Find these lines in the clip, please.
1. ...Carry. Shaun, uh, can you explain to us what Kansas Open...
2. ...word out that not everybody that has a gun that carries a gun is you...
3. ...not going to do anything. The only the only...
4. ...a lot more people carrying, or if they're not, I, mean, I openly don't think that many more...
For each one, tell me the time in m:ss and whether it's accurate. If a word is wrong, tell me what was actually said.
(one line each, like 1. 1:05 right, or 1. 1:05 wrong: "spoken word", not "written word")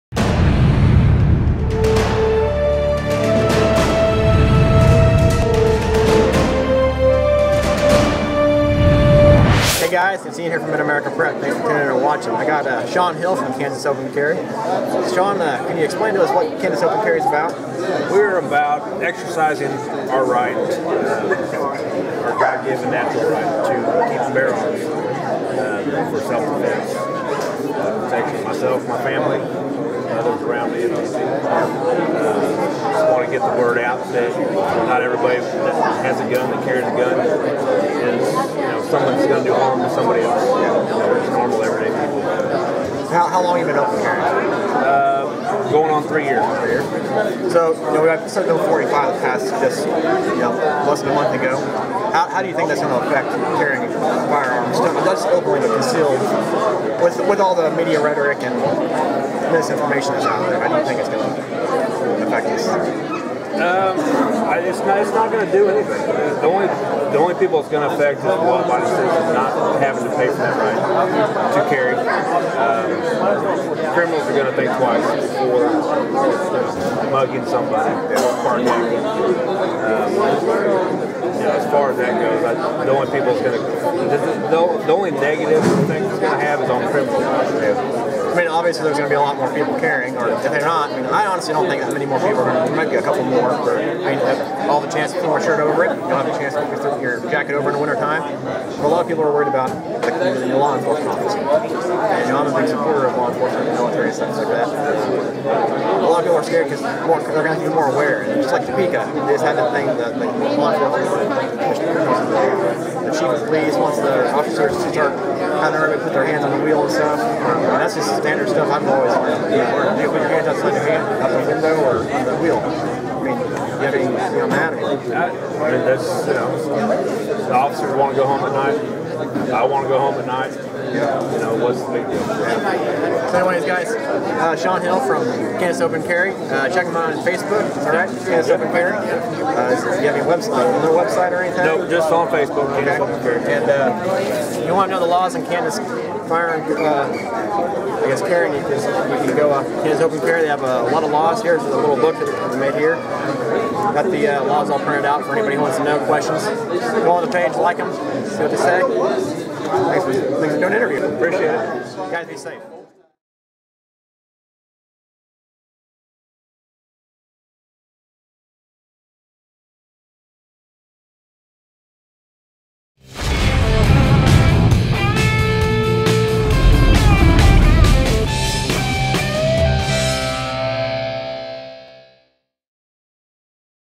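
1. 0:14 right
2. 0:33 right
3. 1:05 right
4. 1:29 wrong: "honestly", not "openly".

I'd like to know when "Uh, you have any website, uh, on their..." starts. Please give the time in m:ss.
2:18.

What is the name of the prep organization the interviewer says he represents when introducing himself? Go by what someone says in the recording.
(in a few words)
Mid-America Prep.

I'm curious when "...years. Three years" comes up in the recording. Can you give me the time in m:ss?
0:46.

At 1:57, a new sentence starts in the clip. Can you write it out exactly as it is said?
And um, that's just standard stuff I've always learned.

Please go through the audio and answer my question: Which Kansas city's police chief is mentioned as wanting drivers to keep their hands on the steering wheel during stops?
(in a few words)
Topeka.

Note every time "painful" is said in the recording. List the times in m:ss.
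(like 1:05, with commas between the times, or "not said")
not said.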